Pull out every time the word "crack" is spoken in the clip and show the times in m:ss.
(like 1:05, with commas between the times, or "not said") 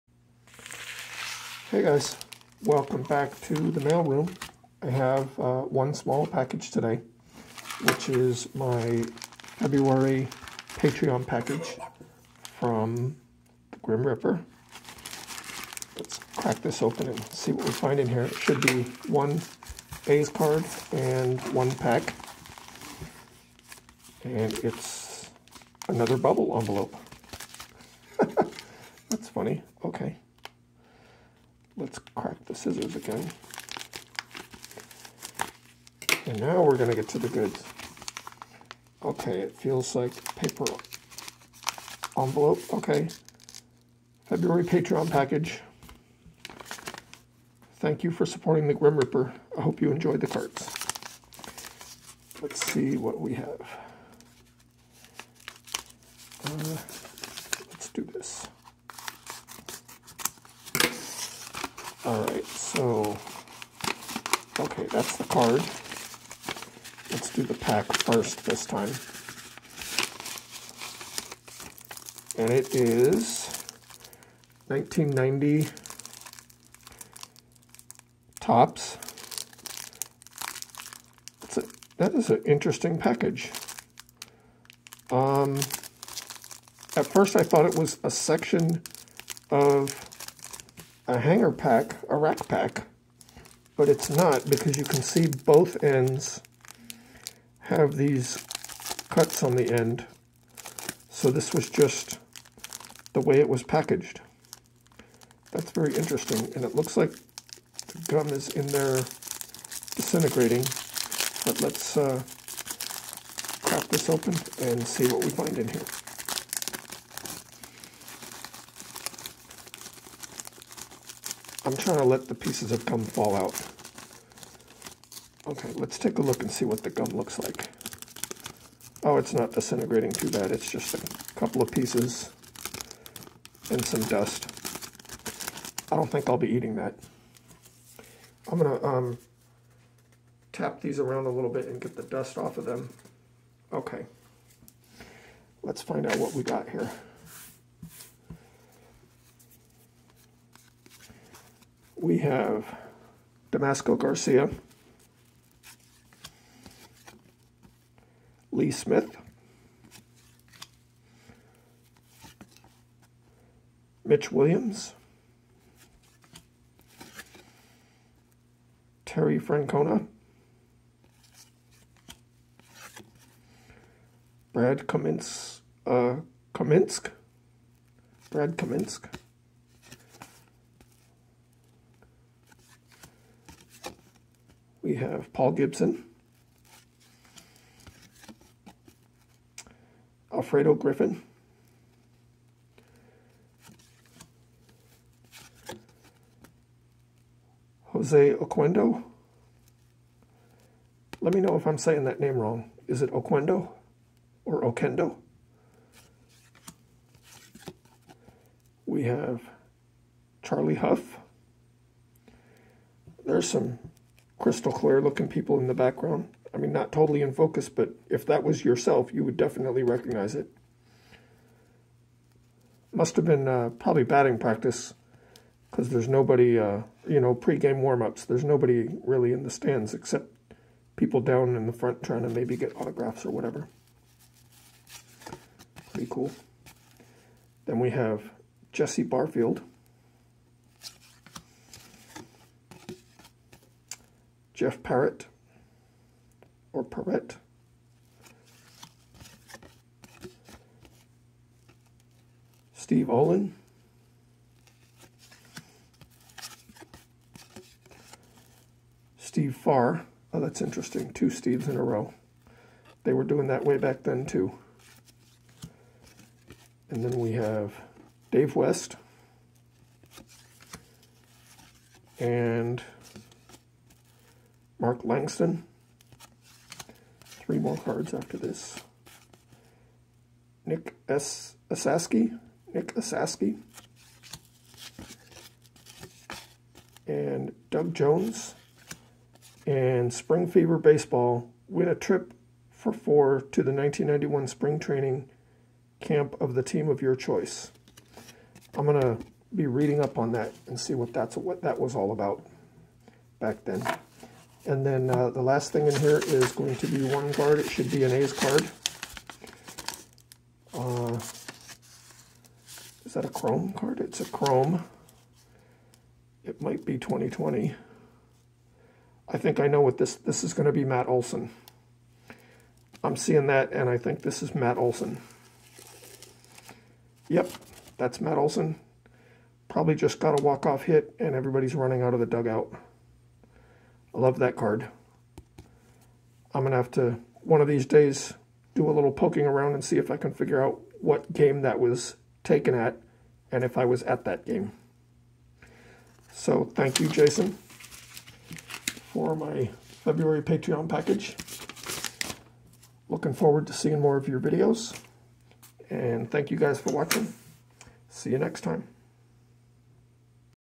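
0:16, 0:32, 1:53.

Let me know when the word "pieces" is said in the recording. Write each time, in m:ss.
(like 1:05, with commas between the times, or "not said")
2:02, 2:11.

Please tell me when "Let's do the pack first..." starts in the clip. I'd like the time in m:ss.
1:07.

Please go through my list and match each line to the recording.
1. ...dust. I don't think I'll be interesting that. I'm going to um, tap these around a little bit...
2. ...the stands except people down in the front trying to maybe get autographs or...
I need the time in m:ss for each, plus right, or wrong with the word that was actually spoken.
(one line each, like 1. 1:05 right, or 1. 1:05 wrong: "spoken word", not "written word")
1. 2:14 wrong: "eating", not "interesting"
2. 3:49 right.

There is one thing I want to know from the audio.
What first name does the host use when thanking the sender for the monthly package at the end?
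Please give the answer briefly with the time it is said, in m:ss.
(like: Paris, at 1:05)
Jason, at 5:47.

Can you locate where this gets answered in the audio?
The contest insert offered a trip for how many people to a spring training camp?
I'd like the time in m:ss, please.
4:52.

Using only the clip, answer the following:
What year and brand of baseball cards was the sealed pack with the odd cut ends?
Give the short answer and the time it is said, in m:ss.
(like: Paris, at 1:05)
1990 Topps, at 1:14.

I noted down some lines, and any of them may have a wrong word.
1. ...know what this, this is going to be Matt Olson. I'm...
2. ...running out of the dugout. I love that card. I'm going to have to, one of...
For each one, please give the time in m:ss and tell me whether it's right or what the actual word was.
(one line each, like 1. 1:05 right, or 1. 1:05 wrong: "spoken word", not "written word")
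1. 5:19 right
2. 5:31 right.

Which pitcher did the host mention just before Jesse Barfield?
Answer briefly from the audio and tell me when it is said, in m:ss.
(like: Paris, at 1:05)
Charlie Hough, at 3:30.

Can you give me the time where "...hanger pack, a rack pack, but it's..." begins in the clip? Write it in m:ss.
1:31.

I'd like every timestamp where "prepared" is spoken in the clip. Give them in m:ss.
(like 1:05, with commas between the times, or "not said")
not said.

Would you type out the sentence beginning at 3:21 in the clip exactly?
Let me know if I'm saying that name wrong.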